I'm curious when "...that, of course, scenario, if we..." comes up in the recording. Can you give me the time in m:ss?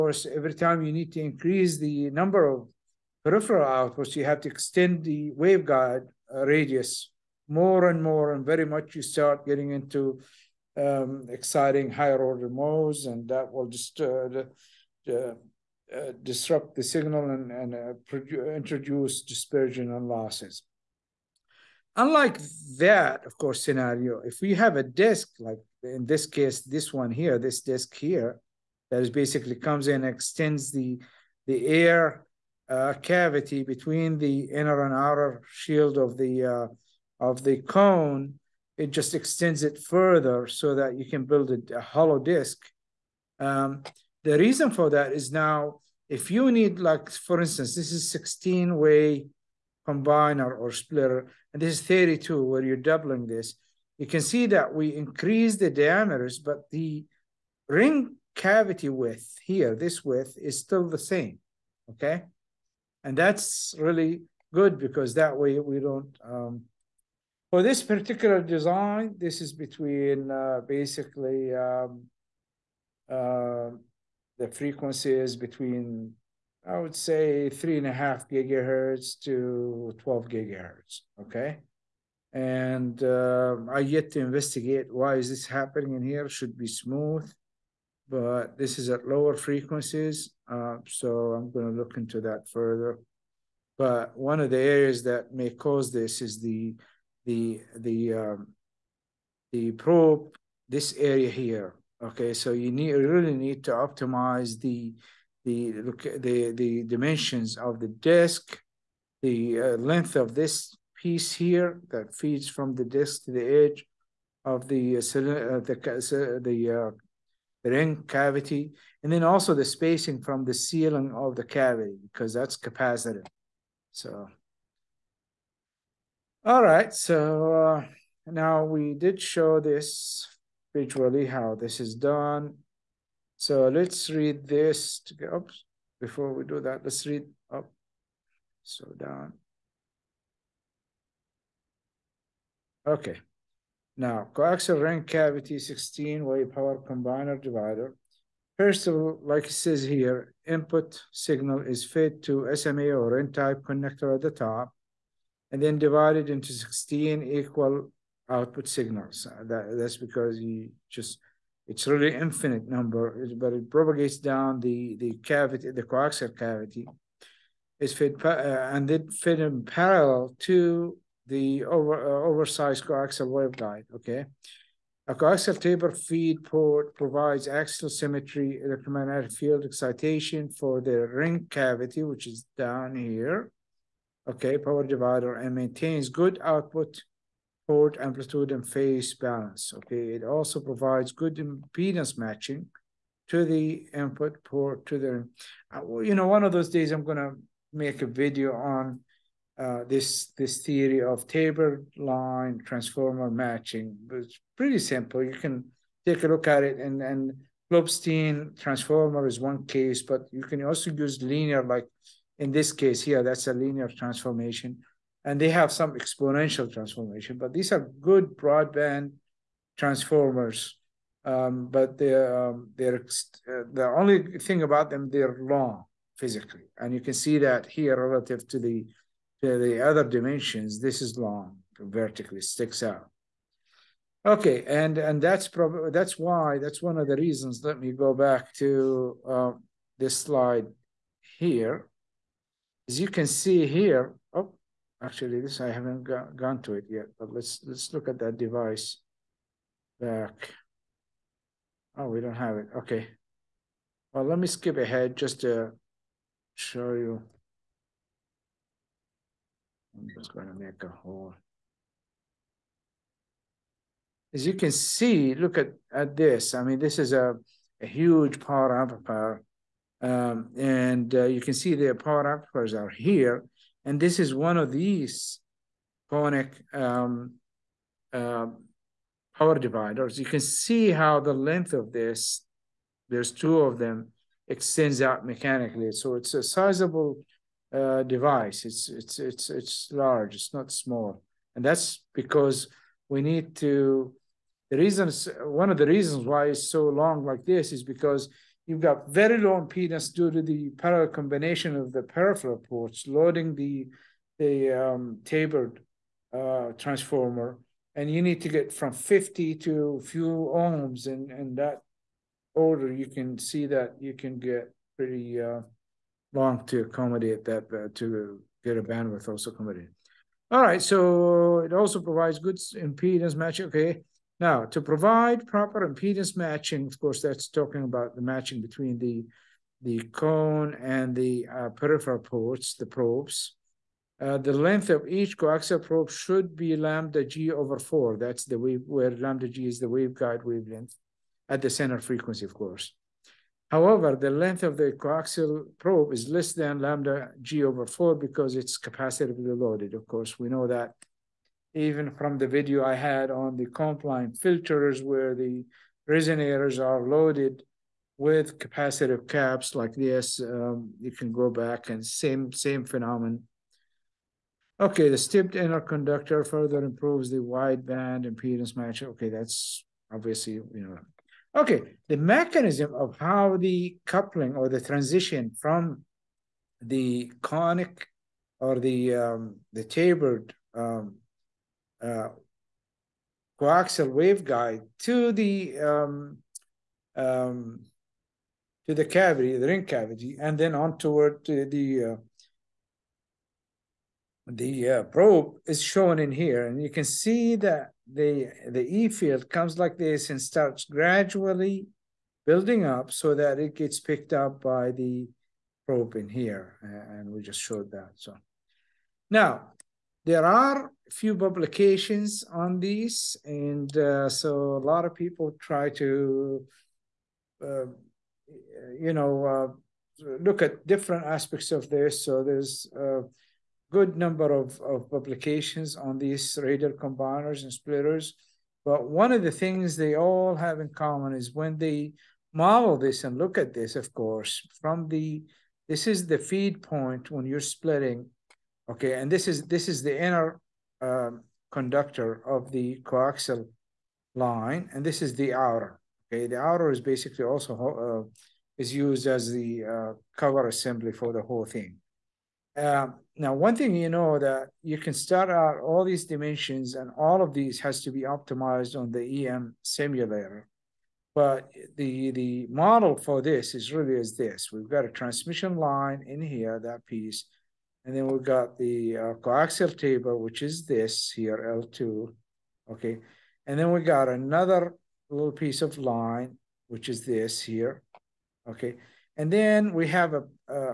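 0:22.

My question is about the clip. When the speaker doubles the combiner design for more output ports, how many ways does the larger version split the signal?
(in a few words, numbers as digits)
32.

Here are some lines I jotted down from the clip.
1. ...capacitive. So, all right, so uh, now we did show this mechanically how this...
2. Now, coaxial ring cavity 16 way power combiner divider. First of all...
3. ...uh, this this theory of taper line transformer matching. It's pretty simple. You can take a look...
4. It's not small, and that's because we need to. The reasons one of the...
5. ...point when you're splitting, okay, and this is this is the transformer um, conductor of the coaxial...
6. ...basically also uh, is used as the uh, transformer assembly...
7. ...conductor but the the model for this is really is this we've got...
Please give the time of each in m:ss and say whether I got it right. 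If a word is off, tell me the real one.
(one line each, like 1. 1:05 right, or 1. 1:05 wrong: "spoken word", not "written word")
1. 2:02 wrong: "visually", not "mechanically"
2. 2:23 right
3. 3:19 right
4. 4:50 right
5. 7:16 wrong: "inner", not "transformer"
6. 7:27 wrong: "cover", not "transformer"
7. 7:39 wrong: "simulator", not "conductor".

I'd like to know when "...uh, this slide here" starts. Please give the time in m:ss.
3:59.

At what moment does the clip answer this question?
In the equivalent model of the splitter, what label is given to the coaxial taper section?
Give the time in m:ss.
7:51.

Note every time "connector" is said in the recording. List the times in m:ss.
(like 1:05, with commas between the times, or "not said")
2:33.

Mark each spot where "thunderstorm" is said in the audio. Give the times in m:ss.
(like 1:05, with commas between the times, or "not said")
not said.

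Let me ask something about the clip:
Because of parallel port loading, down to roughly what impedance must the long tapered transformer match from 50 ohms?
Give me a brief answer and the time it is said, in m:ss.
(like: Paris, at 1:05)
few ohms, at 5:10.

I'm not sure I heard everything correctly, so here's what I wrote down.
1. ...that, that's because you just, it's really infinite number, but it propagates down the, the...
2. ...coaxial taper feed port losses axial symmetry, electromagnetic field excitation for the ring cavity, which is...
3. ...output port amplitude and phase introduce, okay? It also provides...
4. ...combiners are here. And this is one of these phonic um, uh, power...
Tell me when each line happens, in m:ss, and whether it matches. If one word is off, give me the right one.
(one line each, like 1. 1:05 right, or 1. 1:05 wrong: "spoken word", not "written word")
1. 2:39 right
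2. 2:55 wrong: "provides", not "losses"
3. 3:06 wrong: "balance", not "introduce"
4. 4:32 wrong: "amplifiers", not "combiners".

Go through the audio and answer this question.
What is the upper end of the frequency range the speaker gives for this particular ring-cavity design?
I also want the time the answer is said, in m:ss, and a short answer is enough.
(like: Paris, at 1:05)
12 GHz, at 1:19.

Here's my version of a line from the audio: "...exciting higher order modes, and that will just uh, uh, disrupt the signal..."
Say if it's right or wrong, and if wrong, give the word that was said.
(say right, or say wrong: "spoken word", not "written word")
right.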